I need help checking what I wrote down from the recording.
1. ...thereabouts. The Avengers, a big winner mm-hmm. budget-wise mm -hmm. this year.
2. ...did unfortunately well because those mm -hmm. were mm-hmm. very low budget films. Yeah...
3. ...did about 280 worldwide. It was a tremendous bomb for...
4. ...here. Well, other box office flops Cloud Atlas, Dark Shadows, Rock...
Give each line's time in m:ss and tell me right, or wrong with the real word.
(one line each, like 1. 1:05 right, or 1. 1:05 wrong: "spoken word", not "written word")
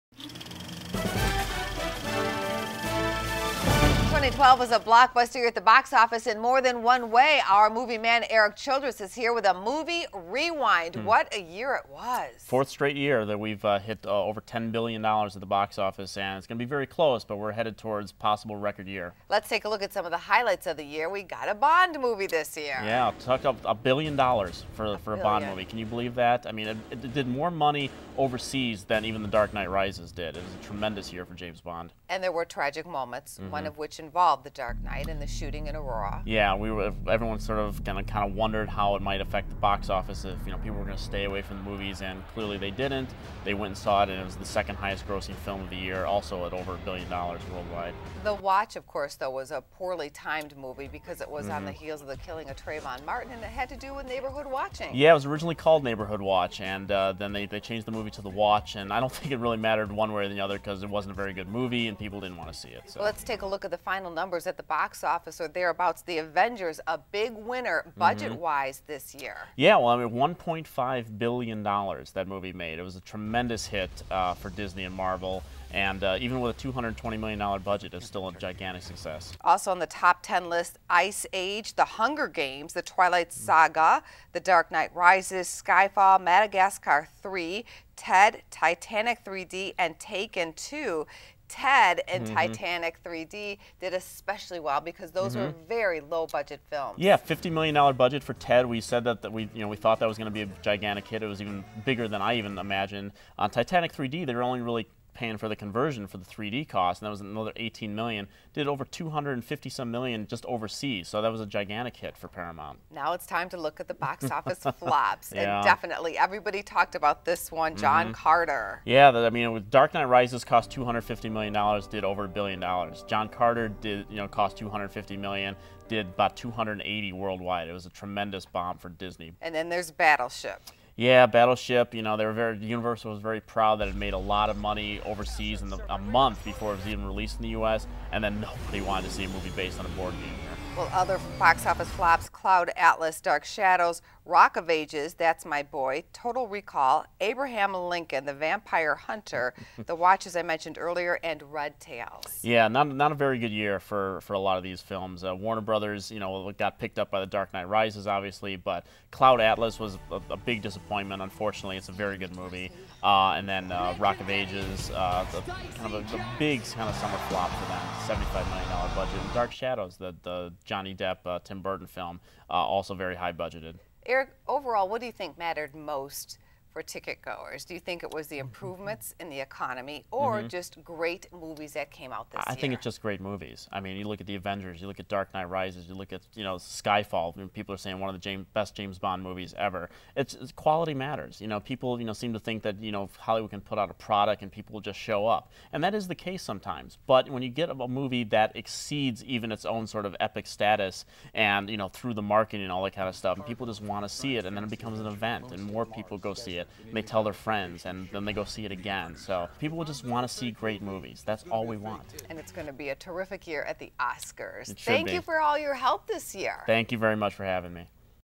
1. 1:05 right
2. 1:33 wrong: "especially", not "unfortunately"
3. 2:05 right
4. 2:20 right.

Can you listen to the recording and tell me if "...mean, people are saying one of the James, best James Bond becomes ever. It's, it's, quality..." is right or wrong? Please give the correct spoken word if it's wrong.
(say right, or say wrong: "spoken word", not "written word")
wrong: "movies", not "becomes".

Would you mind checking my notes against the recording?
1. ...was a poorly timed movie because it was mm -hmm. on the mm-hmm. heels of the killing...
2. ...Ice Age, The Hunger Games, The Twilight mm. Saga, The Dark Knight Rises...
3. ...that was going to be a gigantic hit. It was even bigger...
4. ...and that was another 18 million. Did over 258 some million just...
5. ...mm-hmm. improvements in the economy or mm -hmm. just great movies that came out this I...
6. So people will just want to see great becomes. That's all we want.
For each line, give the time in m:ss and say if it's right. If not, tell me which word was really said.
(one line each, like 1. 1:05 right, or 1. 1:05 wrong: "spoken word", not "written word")
1. 0:49 right
2. 1:21 right
3. 1:40 right
4. 1:47 wrong: "250", not "258"
5. 2:58 right
6. 3:29 wrong: "movies", not "becomes".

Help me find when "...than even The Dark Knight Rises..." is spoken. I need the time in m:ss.
0:28.